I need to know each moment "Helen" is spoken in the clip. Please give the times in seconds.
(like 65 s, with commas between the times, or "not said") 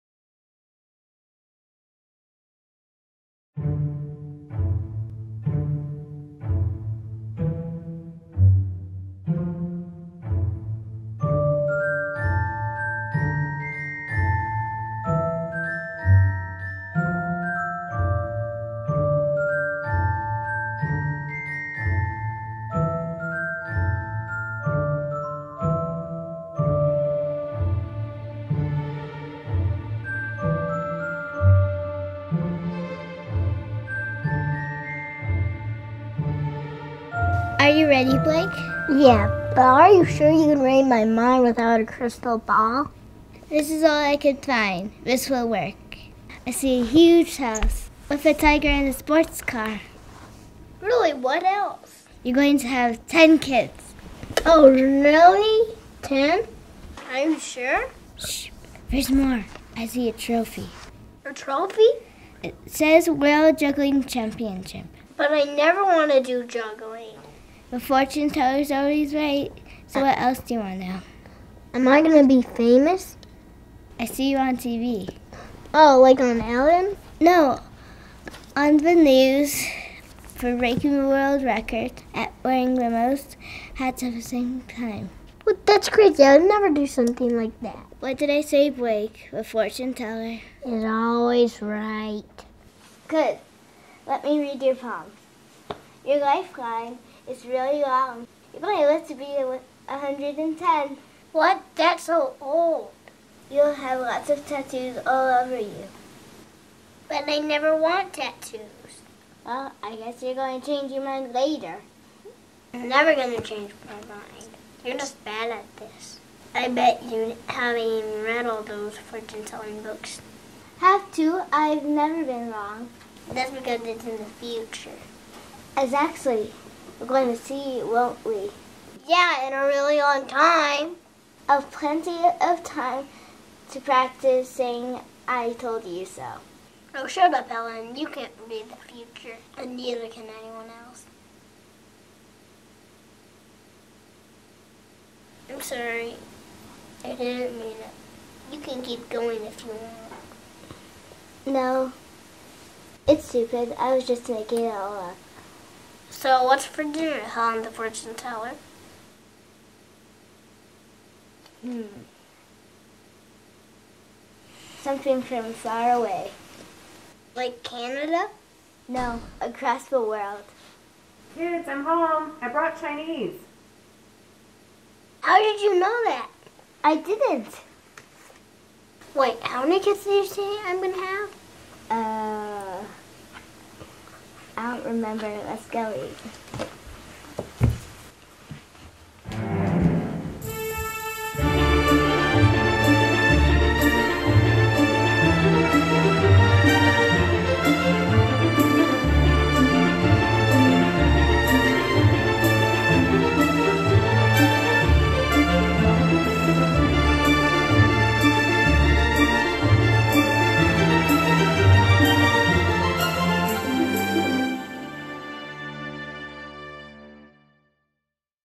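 137 s, 157 s.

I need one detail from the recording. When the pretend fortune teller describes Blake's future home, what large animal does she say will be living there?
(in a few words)
Tiger.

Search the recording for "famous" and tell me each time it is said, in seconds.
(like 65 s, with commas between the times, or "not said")
72 s.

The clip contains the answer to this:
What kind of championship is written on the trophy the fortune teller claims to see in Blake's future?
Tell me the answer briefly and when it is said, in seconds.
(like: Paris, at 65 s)
World Juggling Championship, at 63 s.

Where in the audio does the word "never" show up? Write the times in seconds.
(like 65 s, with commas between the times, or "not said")
65 s, 86 s, 107 s, 112 s, 121 s.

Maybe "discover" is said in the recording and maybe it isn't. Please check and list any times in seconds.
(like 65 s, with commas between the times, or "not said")
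not said.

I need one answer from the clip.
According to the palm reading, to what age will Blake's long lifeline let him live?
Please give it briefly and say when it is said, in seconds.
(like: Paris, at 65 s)
110, at 99 s.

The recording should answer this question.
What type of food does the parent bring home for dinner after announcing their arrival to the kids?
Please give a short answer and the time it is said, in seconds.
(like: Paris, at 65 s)
Chinese, at 172 s.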